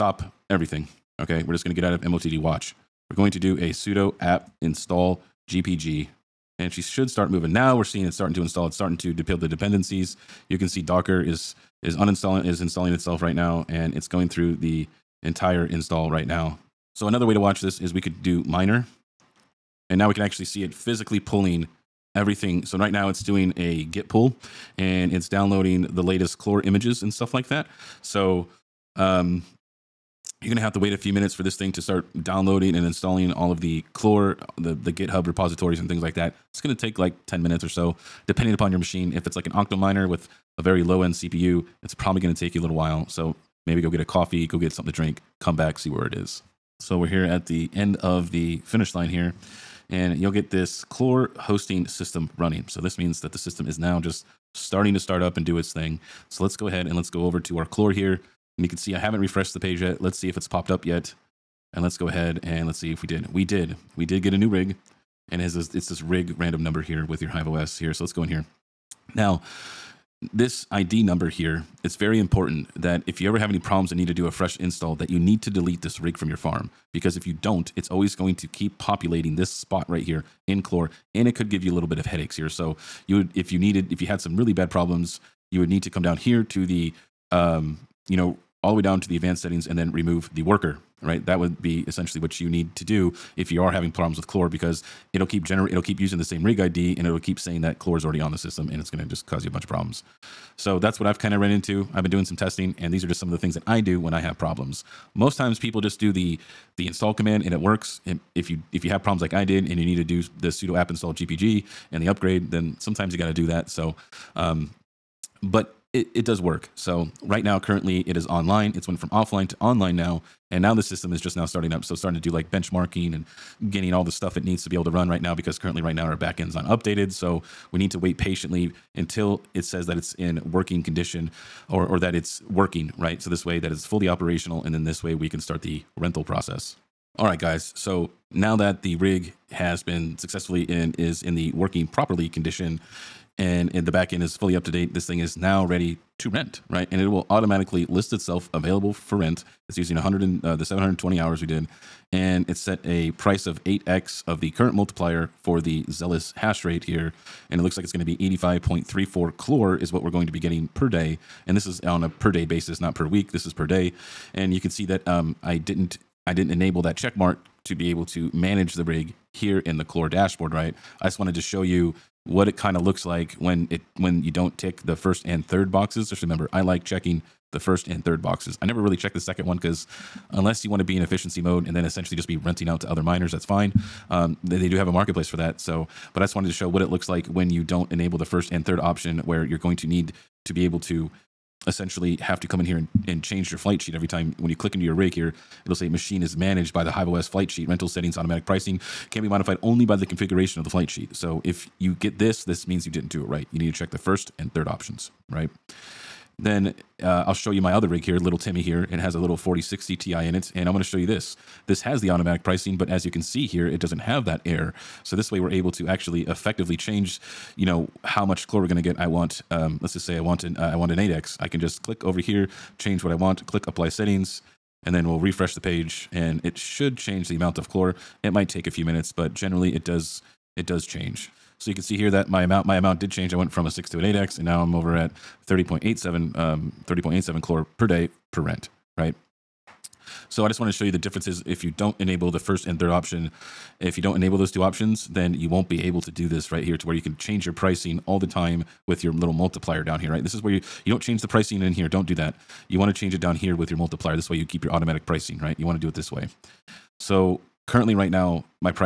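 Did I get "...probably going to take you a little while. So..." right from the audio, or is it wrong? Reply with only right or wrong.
right.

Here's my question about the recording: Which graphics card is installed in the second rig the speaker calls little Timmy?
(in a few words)
4060 Ti.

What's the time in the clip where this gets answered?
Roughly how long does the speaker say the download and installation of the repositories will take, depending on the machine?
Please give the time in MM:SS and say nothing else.
00:37.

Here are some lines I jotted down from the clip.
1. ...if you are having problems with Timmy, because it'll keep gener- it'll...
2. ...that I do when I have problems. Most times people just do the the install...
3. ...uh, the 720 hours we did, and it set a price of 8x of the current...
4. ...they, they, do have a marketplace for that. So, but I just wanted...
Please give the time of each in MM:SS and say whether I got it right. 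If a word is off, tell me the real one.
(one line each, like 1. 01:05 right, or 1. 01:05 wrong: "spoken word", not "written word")
1. 01:33 wrong: "Clore", not "Timmy"
2. 01:43 right
3. 02:30 right
4. 03:04 right.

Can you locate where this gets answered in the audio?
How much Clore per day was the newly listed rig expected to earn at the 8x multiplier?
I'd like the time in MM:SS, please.
02:38.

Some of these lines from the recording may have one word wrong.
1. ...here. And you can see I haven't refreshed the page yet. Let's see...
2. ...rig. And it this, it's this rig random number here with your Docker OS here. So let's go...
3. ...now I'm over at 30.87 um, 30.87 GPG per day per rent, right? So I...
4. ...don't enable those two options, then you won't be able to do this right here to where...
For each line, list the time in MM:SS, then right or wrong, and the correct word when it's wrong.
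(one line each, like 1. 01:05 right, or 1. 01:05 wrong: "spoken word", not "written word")
1. 00:57 right
2. 01:04 wrong: "Hive", not "Docker"
3. 03:54 wrong: "Clore", not "GPG"
4. 04:04 right.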